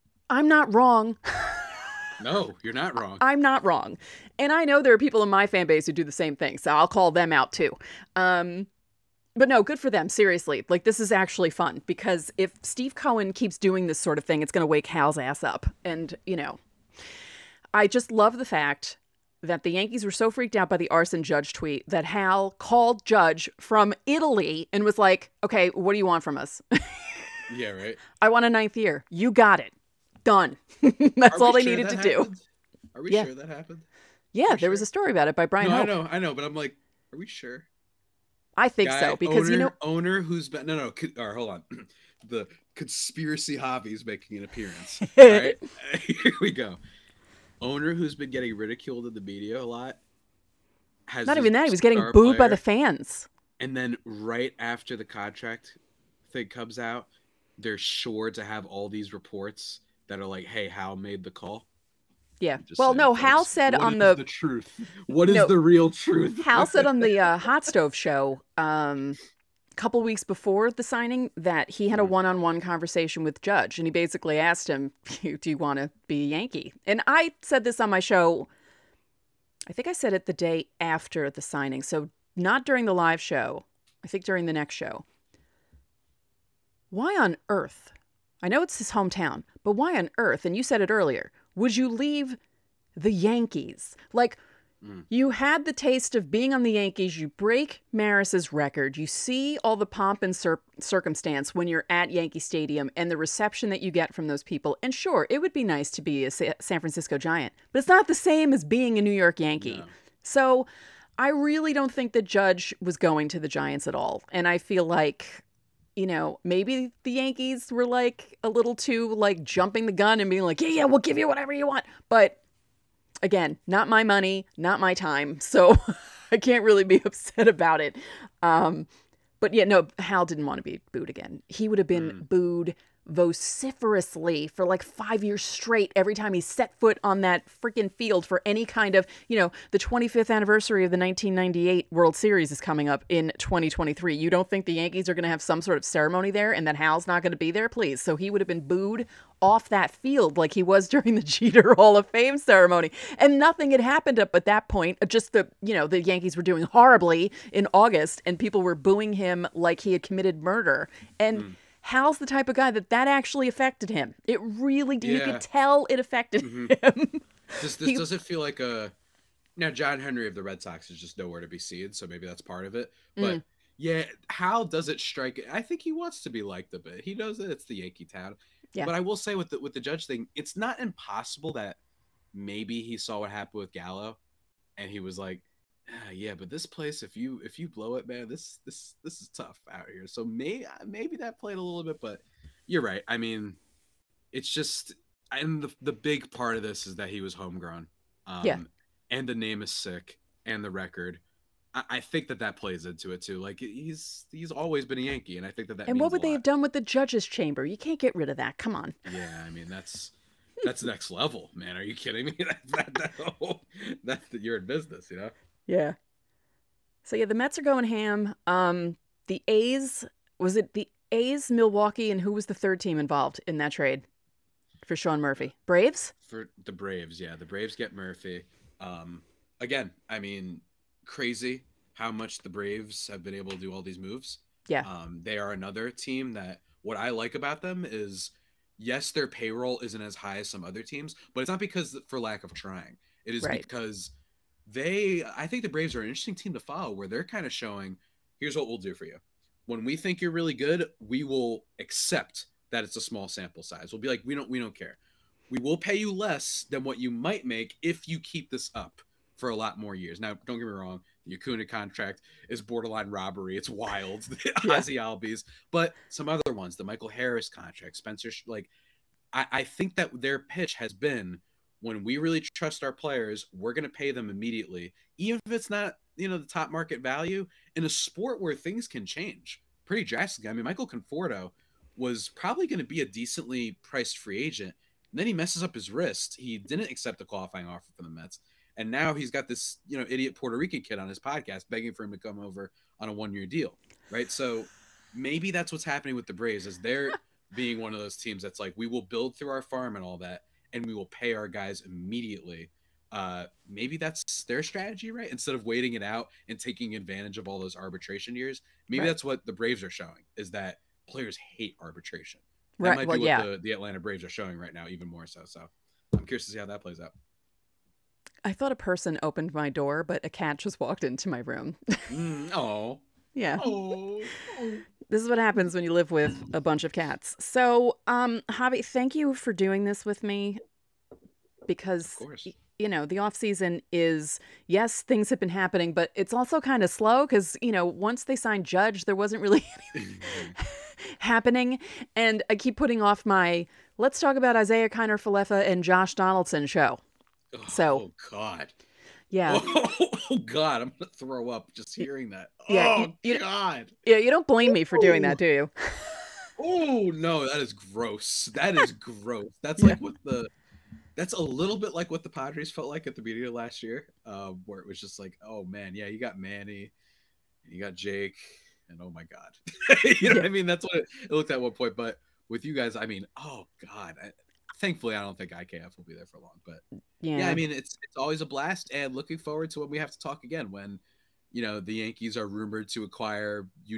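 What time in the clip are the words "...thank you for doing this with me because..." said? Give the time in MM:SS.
05:28.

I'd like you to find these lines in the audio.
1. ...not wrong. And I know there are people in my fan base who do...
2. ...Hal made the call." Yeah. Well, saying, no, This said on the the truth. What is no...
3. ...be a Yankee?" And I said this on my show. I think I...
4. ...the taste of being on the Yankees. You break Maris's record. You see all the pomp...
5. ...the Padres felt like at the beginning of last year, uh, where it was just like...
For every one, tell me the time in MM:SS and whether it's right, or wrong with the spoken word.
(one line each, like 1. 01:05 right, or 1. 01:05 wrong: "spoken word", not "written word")
1. 00:03 right
2. 01:00 wrong: "Hal", not "This"
3. 01:16 right
4. 01:35 right
5. 06:02 right.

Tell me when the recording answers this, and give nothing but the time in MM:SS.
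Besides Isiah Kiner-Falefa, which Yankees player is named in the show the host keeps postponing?
05:45.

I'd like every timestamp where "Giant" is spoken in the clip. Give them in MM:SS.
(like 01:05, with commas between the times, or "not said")
01:47, 01:53.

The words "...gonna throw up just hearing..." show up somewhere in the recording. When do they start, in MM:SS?
05:50.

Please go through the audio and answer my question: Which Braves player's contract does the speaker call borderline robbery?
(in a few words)
Acuna.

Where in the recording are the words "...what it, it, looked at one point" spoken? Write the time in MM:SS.
06:10.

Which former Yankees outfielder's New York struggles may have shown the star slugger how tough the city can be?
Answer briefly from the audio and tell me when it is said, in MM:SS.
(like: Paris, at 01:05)
Gallo, at 03:03.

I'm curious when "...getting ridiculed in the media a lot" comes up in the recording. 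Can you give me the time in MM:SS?
00:48.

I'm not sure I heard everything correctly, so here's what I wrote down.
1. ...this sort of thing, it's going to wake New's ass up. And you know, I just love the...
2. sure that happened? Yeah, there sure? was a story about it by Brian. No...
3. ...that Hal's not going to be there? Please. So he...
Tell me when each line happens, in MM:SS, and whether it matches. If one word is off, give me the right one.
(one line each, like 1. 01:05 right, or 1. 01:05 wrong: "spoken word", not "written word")
1. 00:13 wrong: "Hal", not "New"
2. 00:33 right
3. 02:26 right.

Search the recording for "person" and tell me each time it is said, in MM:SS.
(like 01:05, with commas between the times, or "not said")
05:18.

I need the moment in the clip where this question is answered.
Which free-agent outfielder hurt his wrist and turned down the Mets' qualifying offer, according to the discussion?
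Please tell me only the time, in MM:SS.
04:40.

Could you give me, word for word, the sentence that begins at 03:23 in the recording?
Like he's he's always been a Yankee, and I think that that.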